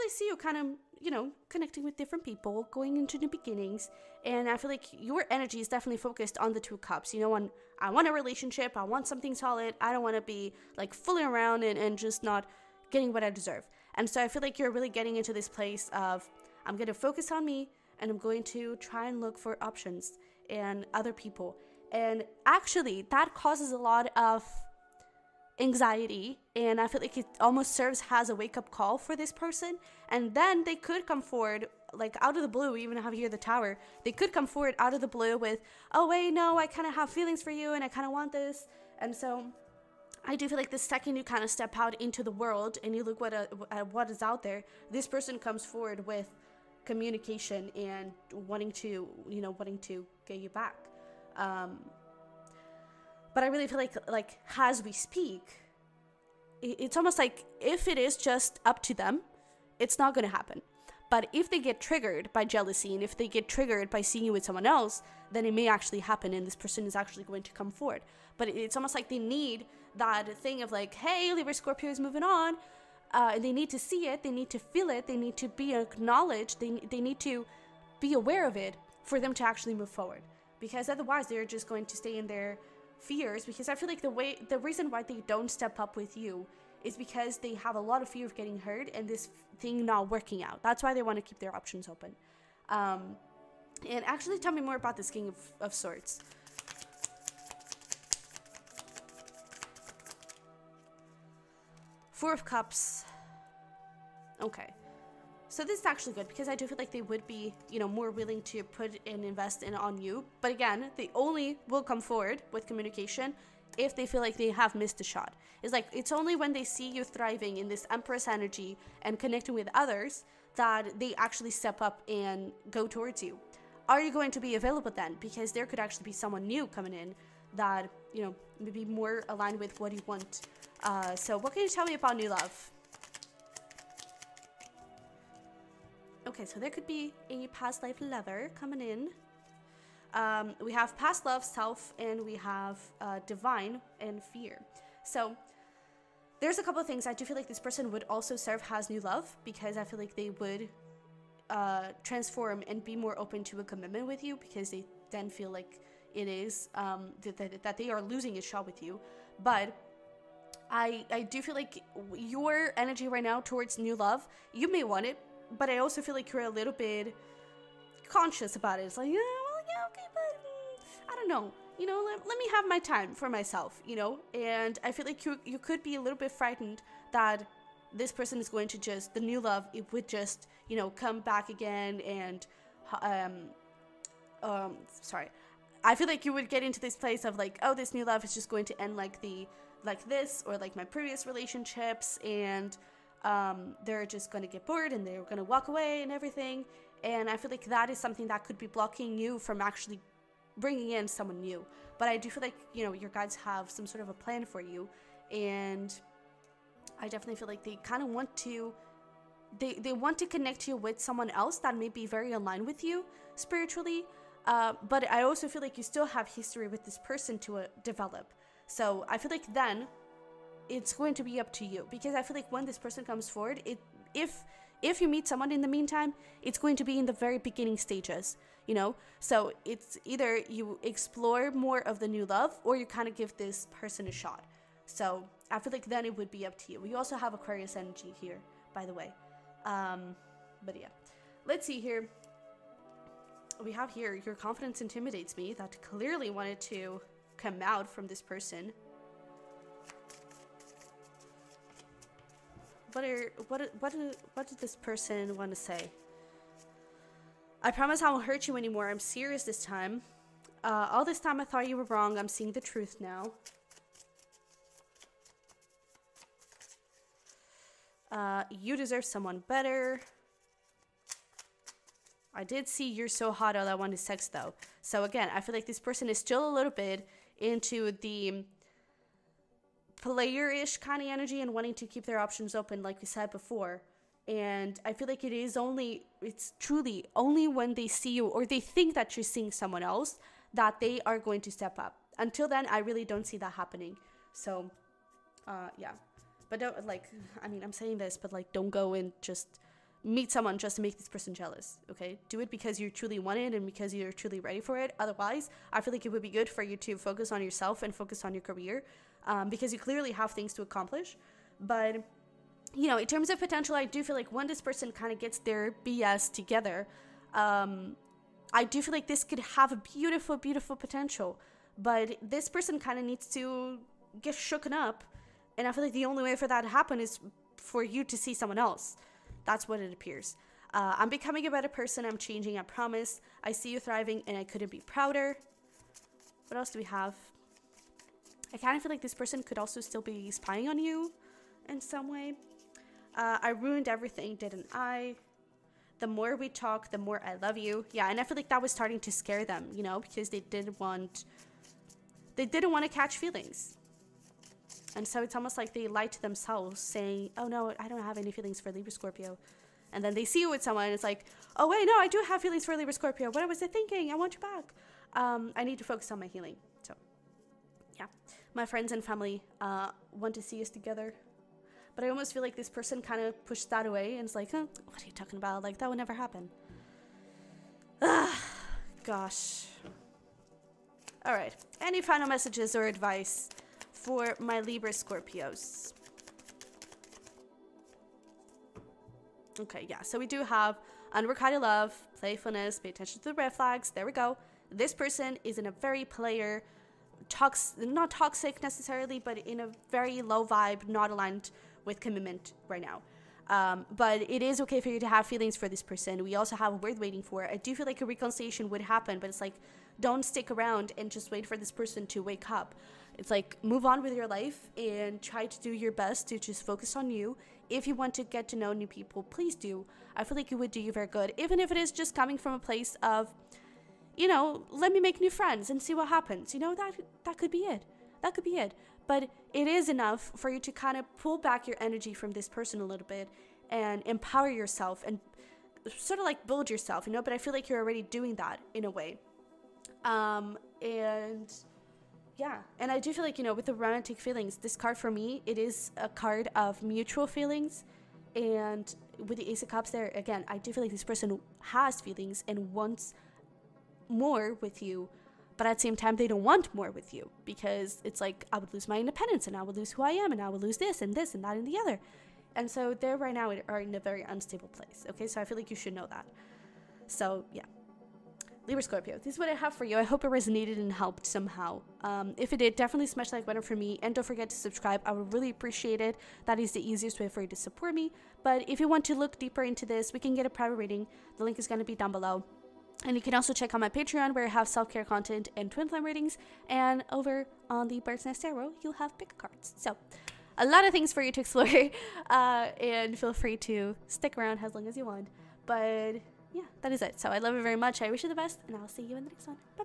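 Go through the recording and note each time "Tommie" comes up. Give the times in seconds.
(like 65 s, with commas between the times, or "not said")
not said.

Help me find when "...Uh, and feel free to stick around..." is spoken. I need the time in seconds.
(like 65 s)
492 s.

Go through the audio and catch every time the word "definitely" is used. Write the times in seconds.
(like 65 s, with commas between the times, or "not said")
5 s, 207 s, 472 s.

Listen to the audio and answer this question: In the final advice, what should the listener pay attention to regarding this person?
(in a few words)
Red flags.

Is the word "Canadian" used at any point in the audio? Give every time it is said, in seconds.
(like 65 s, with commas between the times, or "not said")
not said.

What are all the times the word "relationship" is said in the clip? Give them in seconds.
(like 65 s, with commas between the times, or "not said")
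8 s, 191 s.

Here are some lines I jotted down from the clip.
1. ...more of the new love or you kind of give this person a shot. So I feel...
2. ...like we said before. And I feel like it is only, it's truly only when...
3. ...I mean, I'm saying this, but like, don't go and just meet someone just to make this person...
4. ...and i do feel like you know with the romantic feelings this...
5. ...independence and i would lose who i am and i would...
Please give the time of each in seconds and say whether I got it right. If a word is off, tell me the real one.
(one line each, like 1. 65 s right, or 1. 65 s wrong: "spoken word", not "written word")
1. 231 s right
2. 282 s right
3. 297 s right
4. 442 s right
5. 458 s right.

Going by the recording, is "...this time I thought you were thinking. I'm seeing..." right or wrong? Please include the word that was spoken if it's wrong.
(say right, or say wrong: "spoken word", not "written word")
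wrong: "wrong", not "thinking".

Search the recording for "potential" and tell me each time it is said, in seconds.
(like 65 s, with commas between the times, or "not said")
313 s, 320 s.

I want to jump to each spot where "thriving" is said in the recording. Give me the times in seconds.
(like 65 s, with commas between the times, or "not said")
117 s, 333 s.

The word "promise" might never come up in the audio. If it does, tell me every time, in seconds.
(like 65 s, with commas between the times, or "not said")
257 s, 332 s.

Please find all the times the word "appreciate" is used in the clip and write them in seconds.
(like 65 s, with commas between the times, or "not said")
475 s.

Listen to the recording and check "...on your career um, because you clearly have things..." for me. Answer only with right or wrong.
right.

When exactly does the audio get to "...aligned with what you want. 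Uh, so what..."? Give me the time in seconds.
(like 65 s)
129 s.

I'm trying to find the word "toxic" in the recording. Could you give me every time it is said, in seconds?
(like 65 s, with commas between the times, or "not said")
398 s.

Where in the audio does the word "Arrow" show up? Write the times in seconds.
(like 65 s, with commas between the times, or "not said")
488 s.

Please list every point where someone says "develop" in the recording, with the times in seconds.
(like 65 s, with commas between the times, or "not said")
217 s.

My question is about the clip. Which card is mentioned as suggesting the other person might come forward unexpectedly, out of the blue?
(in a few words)
The Tower.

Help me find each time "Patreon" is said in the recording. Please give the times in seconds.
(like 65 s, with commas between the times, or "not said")
483 s.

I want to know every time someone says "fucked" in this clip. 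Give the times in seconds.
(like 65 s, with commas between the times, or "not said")
not said.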